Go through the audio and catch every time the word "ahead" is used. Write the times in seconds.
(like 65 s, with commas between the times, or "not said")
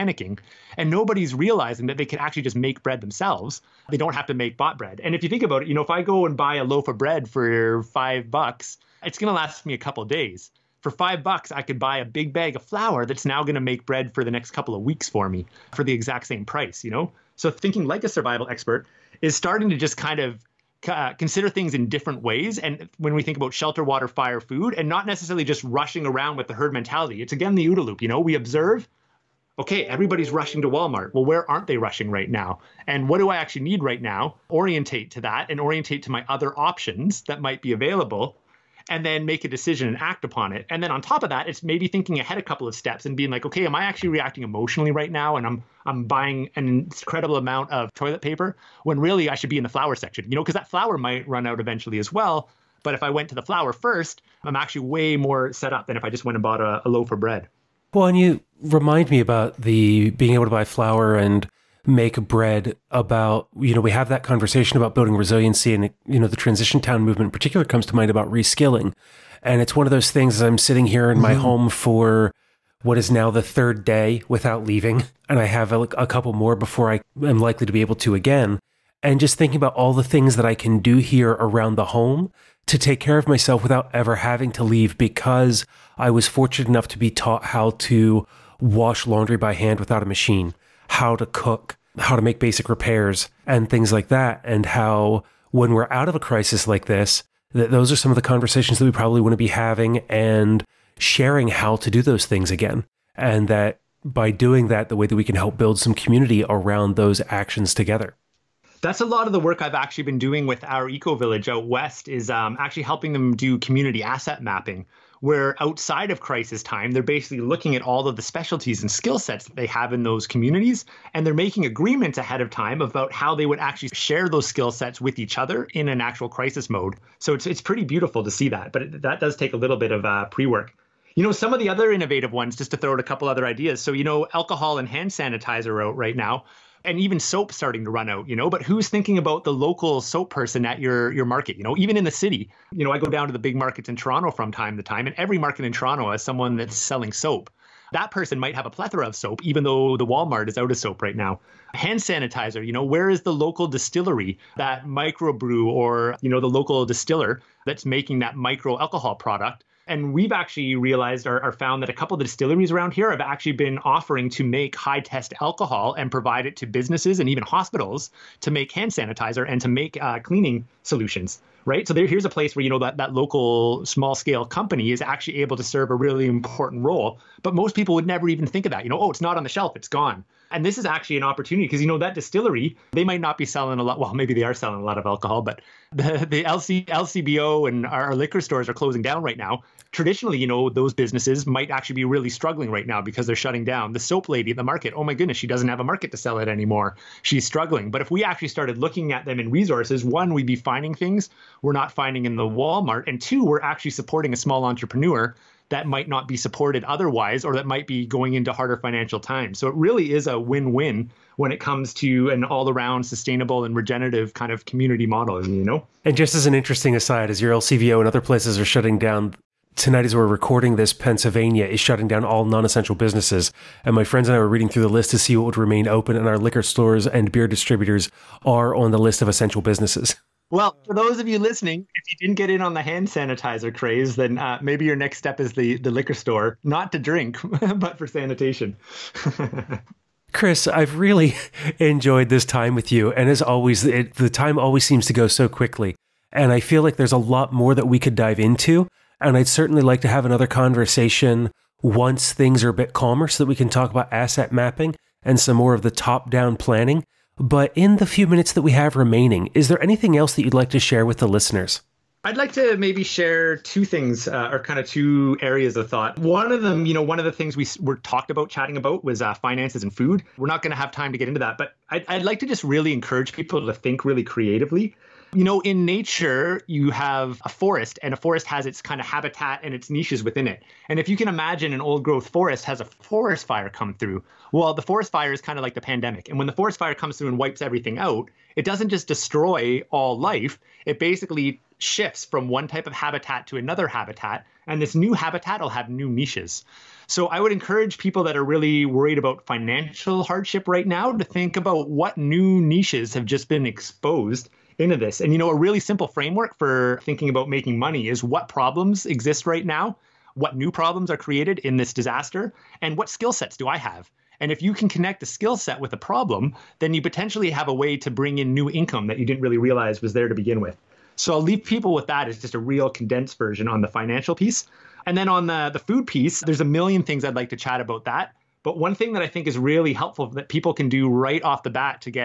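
42 s, 122 s.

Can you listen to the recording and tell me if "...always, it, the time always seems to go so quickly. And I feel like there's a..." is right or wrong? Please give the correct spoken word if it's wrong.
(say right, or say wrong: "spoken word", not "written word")
right.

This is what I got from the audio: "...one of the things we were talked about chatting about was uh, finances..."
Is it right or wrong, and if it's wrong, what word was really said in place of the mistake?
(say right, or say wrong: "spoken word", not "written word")
right.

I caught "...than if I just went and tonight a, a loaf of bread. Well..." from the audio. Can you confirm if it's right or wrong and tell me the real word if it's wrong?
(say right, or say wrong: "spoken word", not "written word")
wrong: "bought", not "tonight".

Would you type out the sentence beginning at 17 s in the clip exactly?
So thinking like a survival expert is starting to just kind of uh, consider things in different ways.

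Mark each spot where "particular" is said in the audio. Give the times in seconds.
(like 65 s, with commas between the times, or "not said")
67 s.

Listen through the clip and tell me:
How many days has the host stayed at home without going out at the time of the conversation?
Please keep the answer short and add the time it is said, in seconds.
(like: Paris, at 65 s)
3, at 73 s.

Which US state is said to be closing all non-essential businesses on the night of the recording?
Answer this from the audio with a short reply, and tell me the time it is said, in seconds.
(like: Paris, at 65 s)
Pennsylvania, at 220 s.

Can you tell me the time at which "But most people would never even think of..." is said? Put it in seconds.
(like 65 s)
177 s.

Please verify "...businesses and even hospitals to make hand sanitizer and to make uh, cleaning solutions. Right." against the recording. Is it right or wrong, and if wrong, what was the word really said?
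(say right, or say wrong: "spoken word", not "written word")
right.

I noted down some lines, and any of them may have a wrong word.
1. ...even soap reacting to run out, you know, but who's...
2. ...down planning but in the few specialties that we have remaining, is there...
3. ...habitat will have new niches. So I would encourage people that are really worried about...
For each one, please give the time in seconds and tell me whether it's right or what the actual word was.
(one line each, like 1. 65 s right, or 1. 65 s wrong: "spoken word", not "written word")
1. 137 s wrong: "starting", not "reacting"
2. 256 s wrong: "minutes", not "specialties"
3. 295 s right.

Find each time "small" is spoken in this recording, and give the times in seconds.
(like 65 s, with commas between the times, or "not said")
173 s, 204 s.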